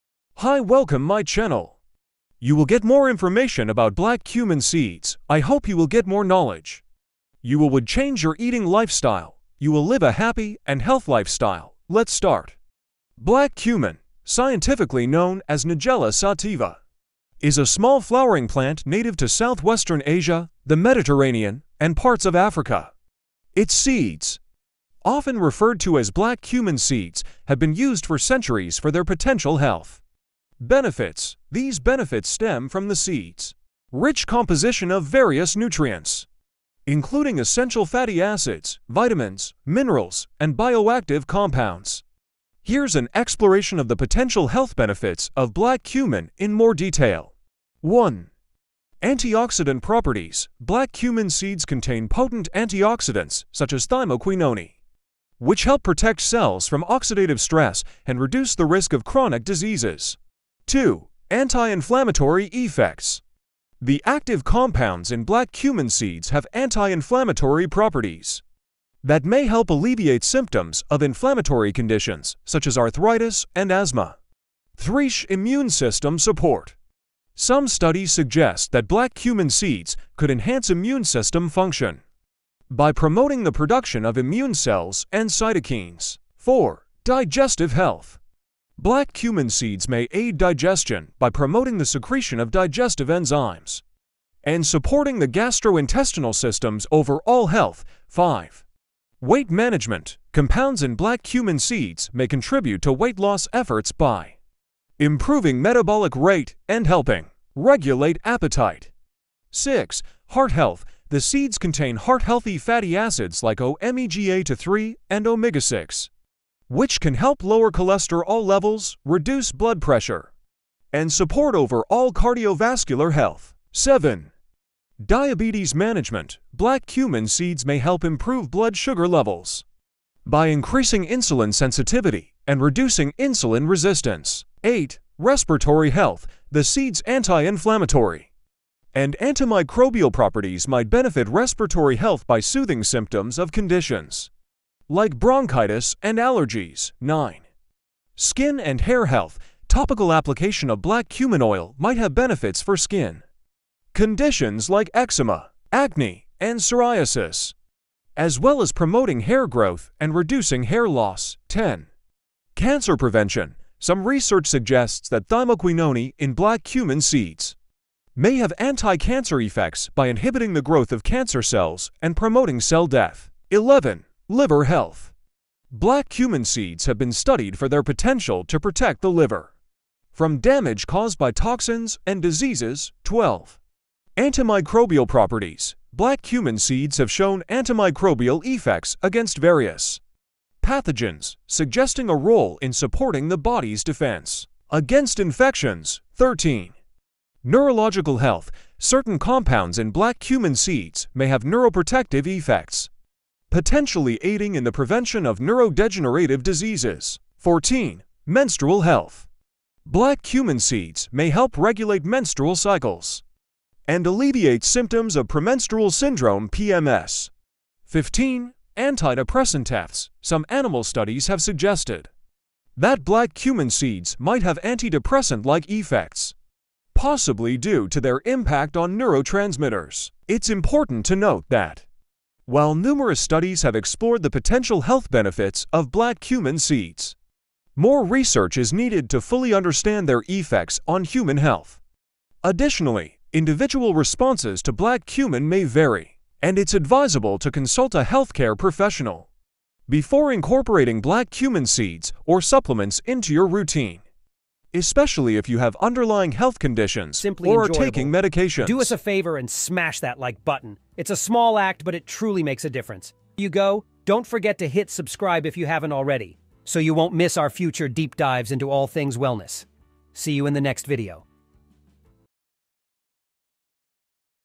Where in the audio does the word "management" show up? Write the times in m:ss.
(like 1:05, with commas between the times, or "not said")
1:39, 2:05.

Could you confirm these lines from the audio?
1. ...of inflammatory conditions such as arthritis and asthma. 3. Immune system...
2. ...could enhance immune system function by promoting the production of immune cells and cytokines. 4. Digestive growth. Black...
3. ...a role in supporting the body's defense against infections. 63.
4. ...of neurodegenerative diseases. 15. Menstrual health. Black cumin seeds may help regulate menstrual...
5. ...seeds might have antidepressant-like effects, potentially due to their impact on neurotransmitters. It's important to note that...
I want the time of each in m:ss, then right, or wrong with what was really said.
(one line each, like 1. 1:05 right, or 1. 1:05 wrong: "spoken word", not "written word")
1. 1:10 right
2. 1:20 wrong: "health", not "growth"
3. 3:12 wrong: "13", not "63"
4. 3:25 wrong: "14", not "15"
5. 3:43 wrong: "possibly", not "potentially".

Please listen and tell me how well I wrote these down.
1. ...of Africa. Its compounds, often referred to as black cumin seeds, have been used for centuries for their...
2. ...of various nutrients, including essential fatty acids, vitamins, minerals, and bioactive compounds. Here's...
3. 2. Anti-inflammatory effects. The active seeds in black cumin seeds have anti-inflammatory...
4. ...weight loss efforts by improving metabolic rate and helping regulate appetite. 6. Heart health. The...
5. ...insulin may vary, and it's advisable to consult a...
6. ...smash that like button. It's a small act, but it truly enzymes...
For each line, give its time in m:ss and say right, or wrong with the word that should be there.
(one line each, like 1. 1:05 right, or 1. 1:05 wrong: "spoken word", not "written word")
1. 0:22 wrong: "seeds", not "compounds"
2. 0:34 right
3. 1:00 wrong: "compounds", not "seeds"
4. 1:42 right
5. 4:05 wrong: "cumin", not "insulin"
6. 4:19 wrong: "makes", not "enzymes".